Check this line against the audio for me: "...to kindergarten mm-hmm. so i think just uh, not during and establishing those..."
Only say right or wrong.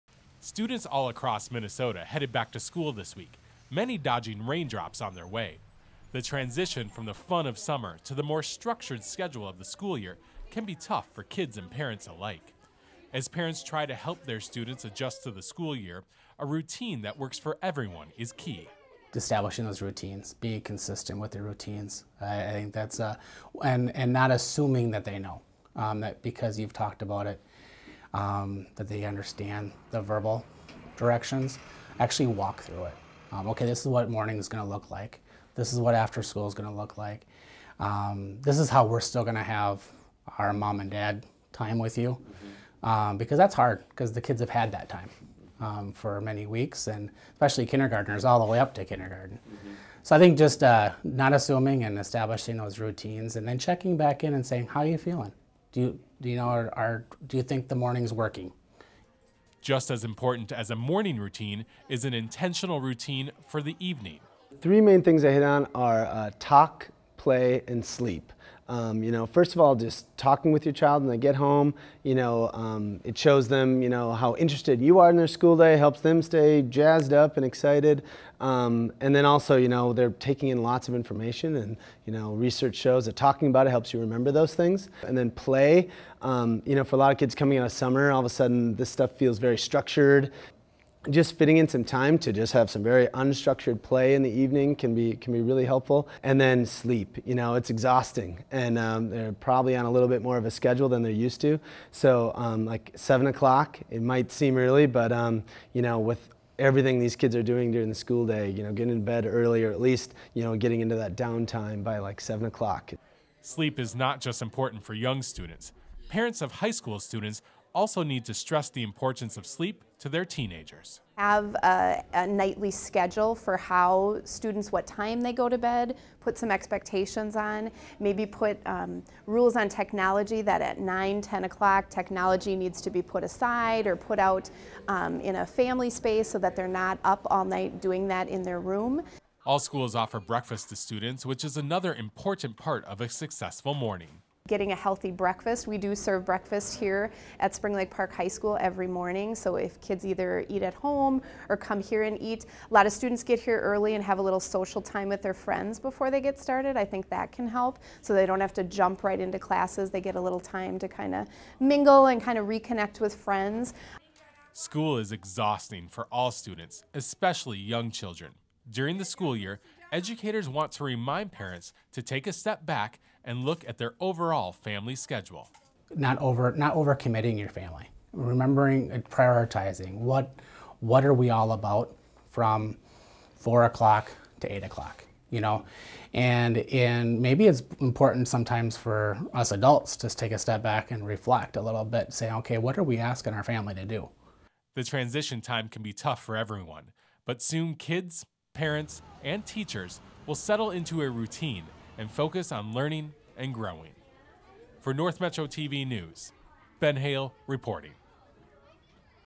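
wrong.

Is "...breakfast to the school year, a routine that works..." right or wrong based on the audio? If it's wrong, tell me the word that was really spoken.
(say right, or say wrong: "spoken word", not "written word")
wrong: "adjust", not "breakfast".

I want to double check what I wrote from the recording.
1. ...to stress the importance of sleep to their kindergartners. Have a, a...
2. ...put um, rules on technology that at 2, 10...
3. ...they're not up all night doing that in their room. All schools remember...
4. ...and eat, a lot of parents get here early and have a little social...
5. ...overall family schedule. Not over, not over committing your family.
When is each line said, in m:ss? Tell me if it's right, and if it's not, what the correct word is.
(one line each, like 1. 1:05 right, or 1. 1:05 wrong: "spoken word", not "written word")
1. 1:58 wrong: "teenagers", not "kindergartners"
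2. 2:08 wrong: "9", not "2"
3. 2:16 wrong: "offer", not "remember"
4. 2:32 wrong: "students", not "parents"
5. 2:53 right.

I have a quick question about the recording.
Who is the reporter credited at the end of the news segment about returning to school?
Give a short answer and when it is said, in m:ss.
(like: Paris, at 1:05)
Ben Hayle, at 3:26.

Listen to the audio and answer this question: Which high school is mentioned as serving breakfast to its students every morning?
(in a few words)
Spring Lake Park High School.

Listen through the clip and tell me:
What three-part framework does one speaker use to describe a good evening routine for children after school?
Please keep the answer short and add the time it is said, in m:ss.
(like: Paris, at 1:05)
talk, play, and sleep, at 1:06.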